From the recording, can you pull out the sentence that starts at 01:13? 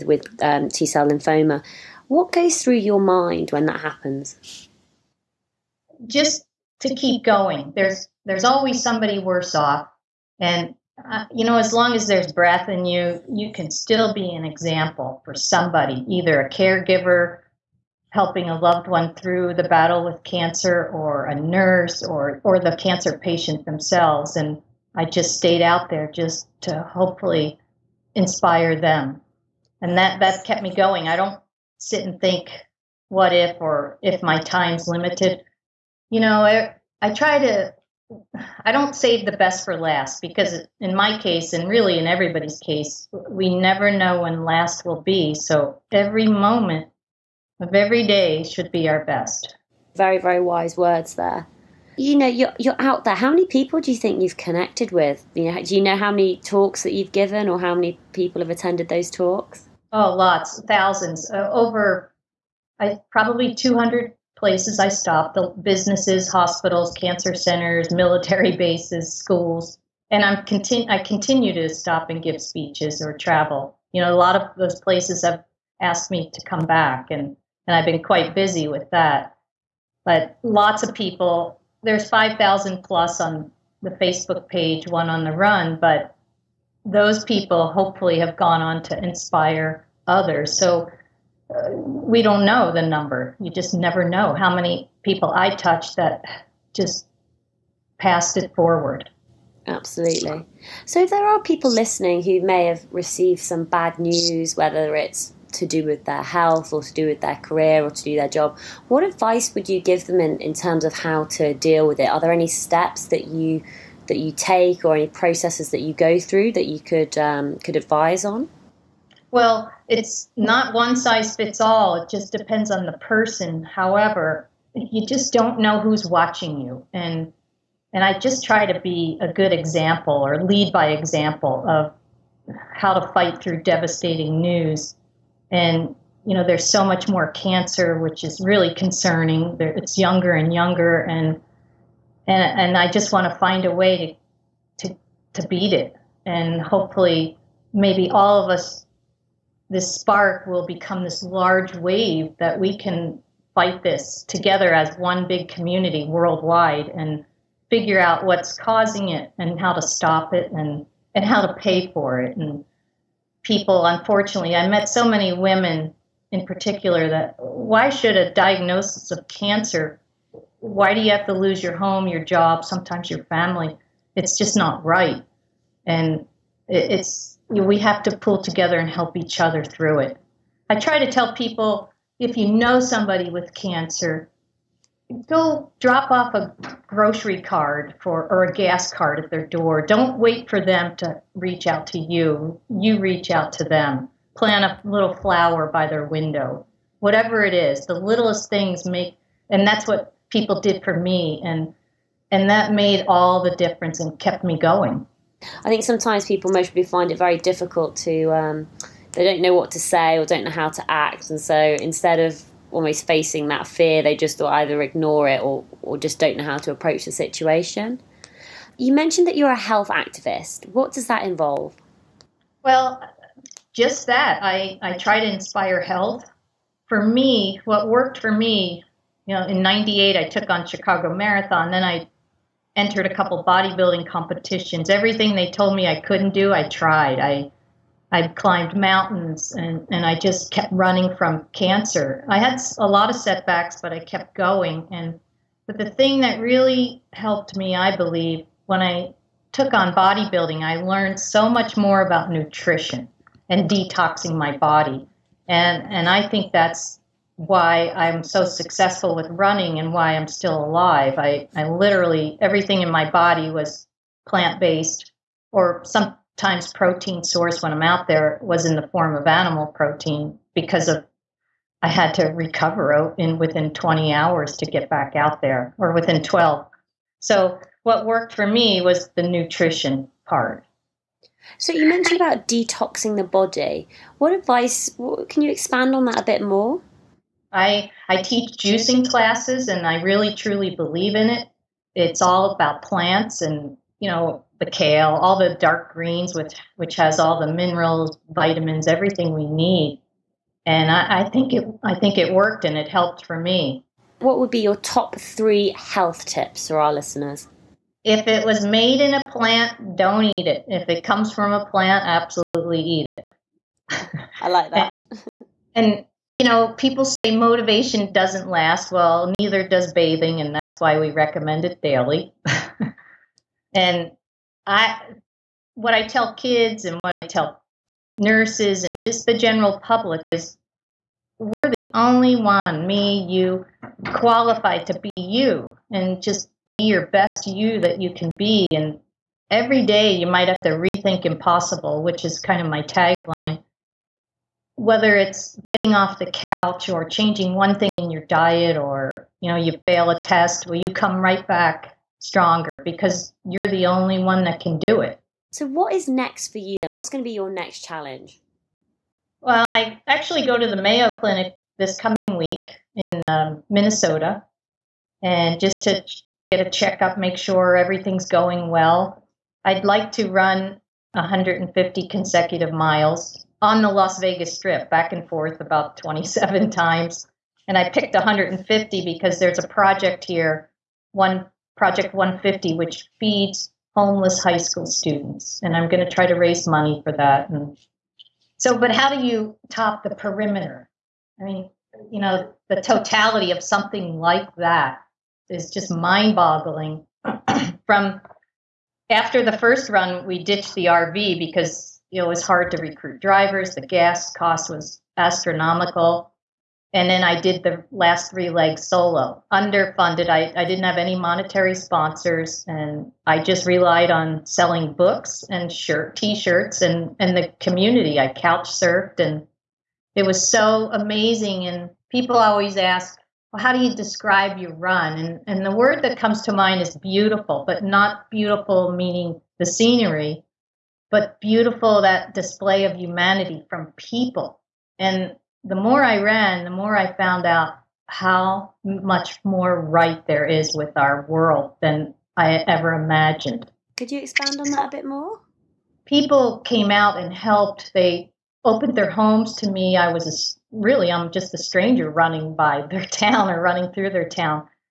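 You know, a lot of those places have asked me to come back, and, and I've been quite busy with that.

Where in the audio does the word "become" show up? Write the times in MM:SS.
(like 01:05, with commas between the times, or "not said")
02:30.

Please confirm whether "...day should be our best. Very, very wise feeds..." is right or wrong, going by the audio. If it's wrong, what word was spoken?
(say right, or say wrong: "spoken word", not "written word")
wrong: "words", not "feeds".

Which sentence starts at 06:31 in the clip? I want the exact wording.
I mean, you know, the totality of something like that is just mind boggling.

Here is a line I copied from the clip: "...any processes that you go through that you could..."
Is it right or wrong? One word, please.
right.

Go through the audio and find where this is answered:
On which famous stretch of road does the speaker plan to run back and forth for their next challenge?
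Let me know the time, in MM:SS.
06:13.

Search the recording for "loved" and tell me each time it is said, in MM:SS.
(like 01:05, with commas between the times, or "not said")
00:18.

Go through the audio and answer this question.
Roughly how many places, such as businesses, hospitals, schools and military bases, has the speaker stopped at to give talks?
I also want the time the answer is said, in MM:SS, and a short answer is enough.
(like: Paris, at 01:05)
200, at 01:03.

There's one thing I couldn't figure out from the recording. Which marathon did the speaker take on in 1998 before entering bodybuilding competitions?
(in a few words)
Chicago Marathon.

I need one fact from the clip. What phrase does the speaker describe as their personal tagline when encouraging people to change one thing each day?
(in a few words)
Rethink impossible.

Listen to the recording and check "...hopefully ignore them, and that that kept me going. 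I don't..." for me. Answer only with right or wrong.
wrong.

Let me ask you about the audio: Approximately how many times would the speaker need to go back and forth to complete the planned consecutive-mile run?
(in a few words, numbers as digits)
27.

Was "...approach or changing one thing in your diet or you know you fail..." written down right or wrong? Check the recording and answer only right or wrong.
wrong.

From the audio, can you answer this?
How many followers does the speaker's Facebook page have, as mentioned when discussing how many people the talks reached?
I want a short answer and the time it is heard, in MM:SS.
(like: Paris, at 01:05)
5,000 plus, at 01:22.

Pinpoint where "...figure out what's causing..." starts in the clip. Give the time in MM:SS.
02:37.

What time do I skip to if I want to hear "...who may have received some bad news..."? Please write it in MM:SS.
01:42.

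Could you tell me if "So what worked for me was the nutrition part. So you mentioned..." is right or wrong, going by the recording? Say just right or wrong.
right.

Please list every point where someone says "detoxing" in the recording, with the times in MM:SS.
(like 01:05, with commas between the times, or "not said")
04:13, 04:42.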